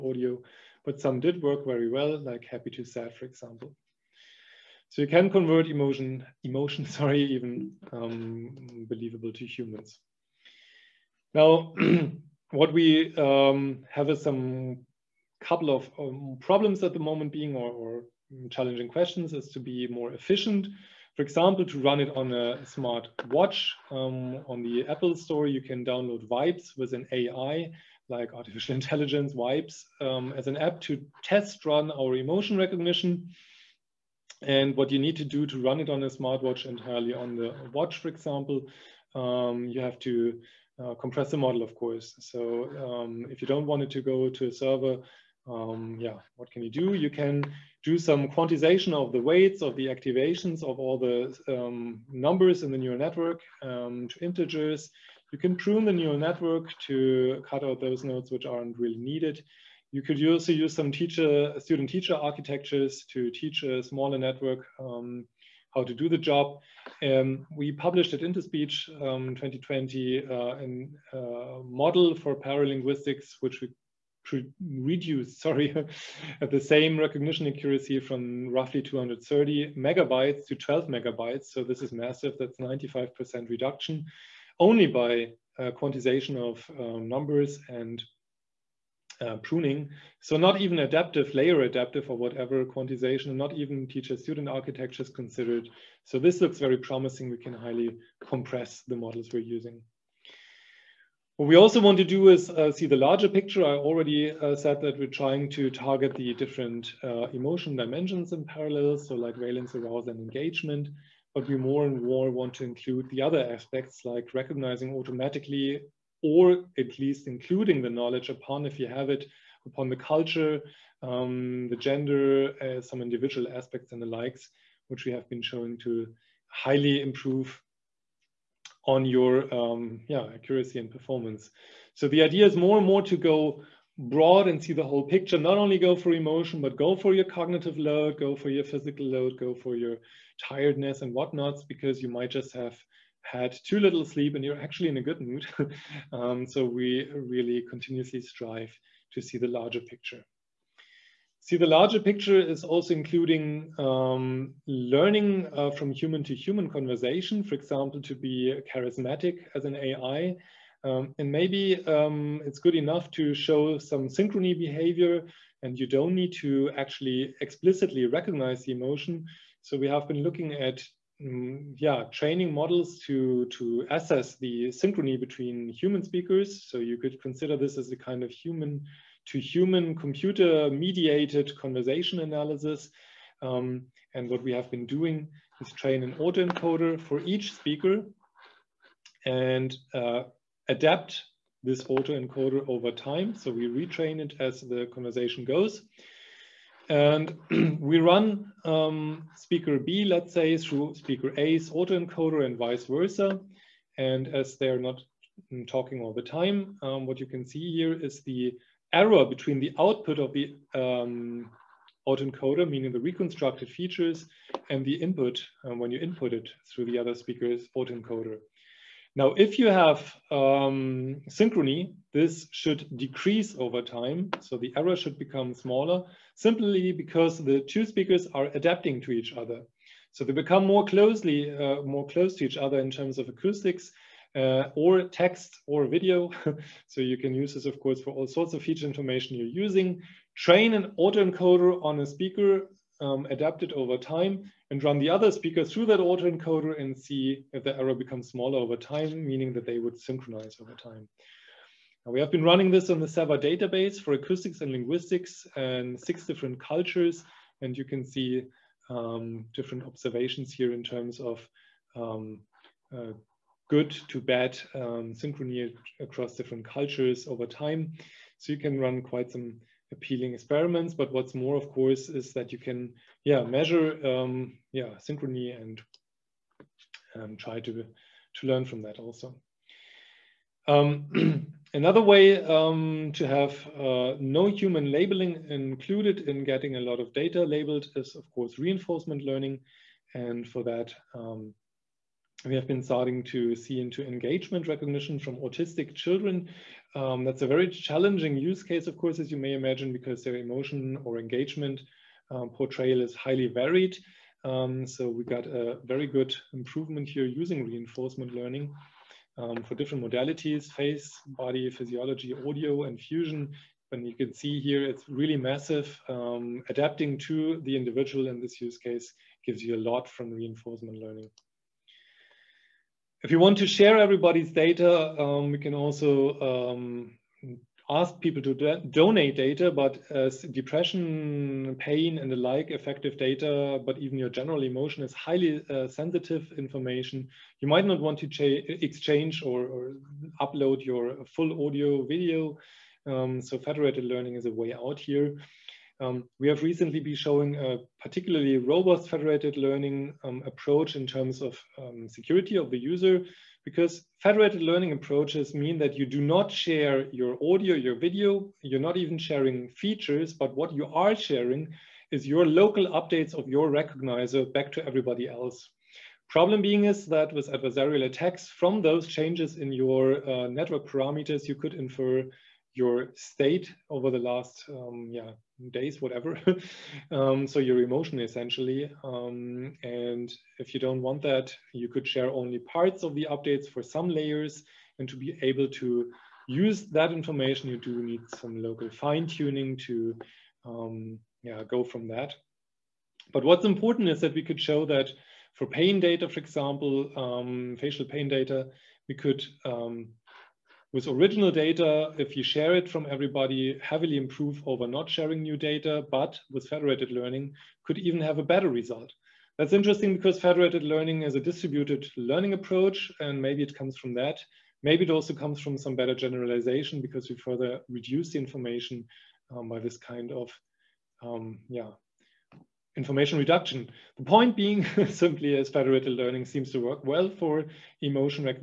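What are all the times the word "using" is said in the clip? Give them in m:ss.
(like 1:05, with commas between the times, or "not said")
1:39, 3:59, 5:07.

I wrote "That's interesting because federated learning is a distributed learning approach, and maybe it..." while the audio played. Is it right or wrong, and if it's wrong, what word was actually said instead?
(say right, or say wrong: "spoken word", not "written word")
right.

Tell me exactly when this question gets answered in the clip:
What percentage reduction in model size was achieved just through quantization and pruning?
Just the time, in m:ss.
1:22.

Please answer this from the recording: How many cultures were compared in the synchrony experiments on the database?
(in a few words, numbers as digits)
6.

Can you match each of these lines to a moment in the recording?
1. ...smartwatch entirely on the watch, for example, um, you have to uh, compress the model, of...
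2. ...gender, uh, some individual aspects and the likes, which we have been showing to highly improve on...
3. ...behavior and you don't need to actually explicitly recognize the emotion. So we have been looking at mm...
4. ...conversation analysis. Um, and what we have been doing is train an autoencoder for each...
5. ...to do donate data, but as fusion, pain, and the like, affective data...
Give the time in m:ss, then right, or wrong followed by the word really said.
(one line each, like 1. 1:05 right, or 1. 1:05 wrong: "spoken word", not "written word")
1. 0:36 right
2. 2:01 right
3. 2:44 right
4. 3:01 right
5. 5:28 wrong: "depression", not "fusion".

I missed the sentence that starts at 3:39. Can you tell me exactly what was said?
Now, if you have um, synchrony, this should decrease over time.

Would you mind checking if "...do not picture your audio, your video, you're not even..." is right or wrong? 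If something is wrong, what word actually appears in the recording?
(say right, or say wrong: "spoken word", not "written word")
wrong: "share", not "picture".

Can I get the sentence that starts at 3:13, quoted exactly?
So we retrain it as the conversation goes.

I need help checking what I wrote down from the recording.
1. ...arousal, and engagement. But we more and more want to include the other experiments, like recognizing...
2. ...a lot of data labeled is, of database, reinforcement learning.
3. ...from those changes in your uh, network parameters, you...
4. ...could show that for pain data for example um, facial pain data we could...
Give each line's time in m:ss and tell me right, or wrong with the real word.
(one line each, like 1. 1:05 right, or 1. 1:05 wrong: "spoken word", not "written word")
1. 1:49 wrong: "aspects", not "experiments"
2. 4:46 wrong: "course", not "database"
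3. 6:08 right
4. 6:34 right.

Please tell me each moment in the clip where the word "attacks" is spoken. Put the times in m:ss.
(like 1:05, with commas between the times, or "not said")
6:08.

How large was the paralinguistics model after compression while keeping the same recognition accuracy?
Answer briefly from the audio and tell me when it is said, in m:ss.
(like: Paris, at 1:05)
12 megabytes, at 1:20.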